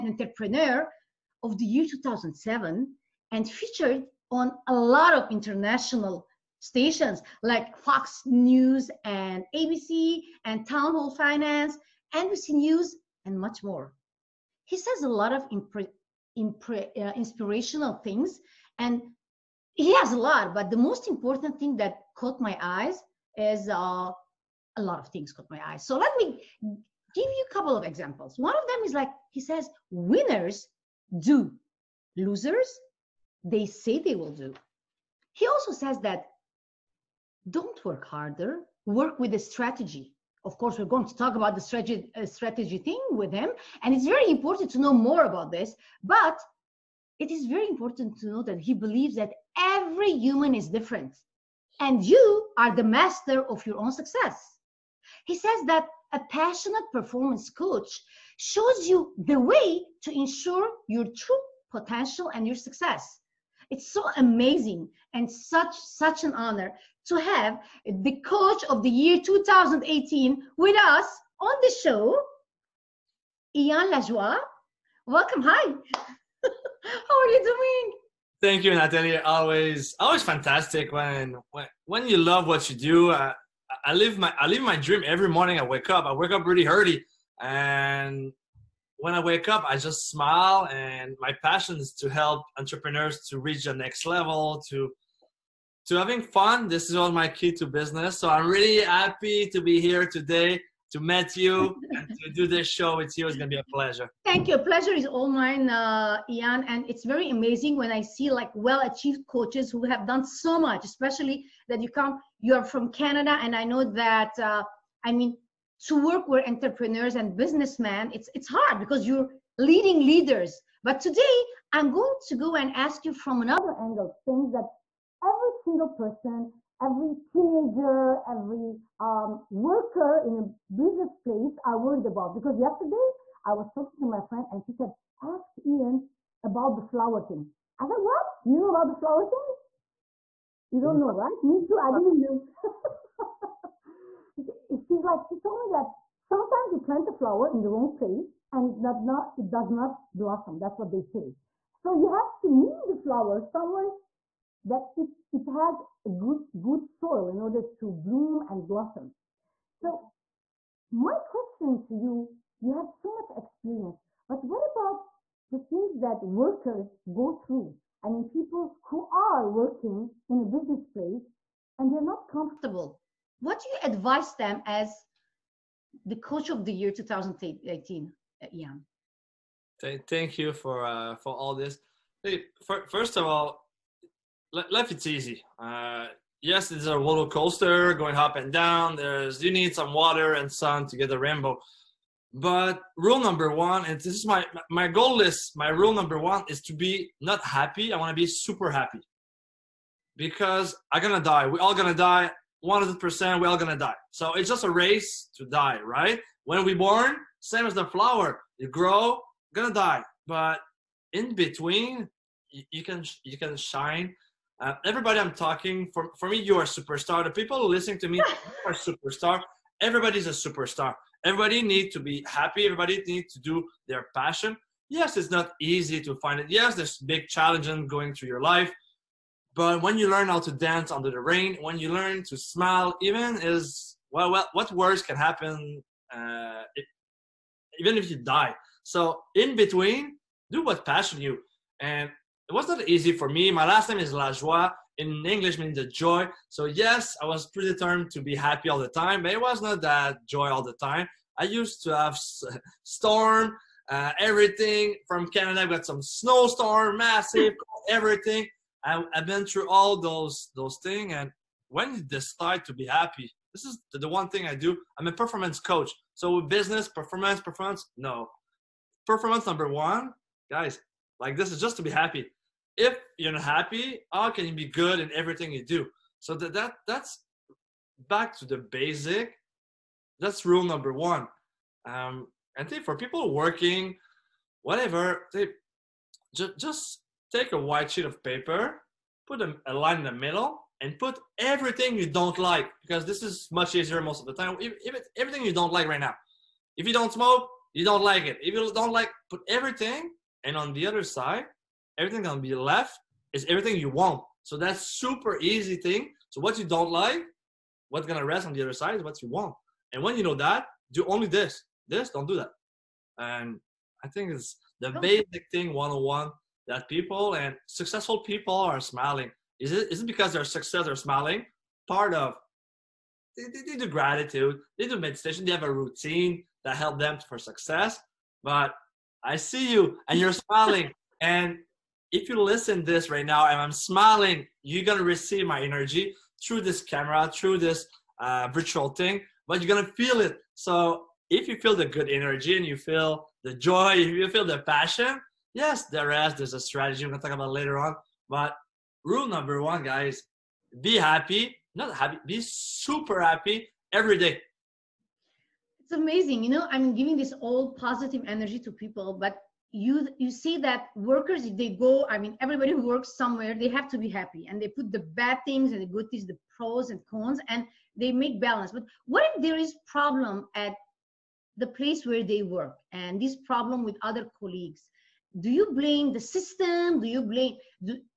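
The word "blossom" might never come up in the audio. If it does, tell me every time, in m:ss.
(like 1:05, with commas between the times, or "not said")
2:30, 2:38.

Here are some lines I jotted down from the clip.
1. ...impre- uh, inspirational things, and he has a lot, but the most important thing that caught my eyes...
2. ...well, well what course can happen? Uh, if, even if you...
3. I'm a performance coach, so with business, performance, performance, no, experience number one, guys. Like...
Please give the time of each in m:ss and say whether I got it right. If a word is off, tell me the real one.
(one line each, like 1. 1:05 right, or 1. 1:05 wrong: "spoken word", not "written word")
1. 0:16 right
2. 3:54 wrong: "worse", not "course"
3. 4:24 wrong: "performance", not "experience".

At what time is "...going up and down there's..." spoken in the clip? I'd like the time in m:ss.
3:07.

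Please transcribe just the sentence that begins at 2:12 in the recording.
Because yesterday, I was talking to my friend and she said, Ask Ian about the flower thing.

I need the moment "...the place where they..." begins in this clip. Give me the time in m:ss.
6:11.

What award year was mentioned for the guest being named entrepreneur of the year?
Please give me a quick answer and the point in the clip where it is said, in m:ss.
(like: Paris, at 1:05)
2007, at 0:01.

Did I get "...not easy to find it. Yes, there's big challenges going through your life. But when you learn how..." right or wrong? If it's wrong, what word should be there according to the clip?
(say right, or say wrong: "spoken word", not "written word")
right.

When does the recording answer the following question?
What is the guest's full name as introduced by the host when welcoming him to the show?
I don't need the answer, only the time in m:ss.
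1:13.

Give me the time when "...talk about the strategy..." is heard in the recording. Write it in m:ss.
0:41.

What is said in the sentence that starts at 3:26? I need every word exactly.
When we born, same as the flower, you grow, gonna die.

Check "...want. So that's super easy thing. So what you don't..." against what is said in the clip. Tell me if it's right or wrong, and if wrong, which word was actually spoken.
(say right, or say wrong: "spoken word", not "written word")
right.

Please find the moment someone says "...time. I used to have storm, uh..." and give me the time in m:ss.
4:10.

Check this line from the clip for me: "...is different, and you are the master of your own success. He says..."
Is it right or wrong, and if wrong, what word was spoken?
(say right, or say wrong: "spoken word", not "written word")
right.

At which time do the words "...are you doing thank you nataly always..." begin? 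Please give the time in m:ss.
1:17.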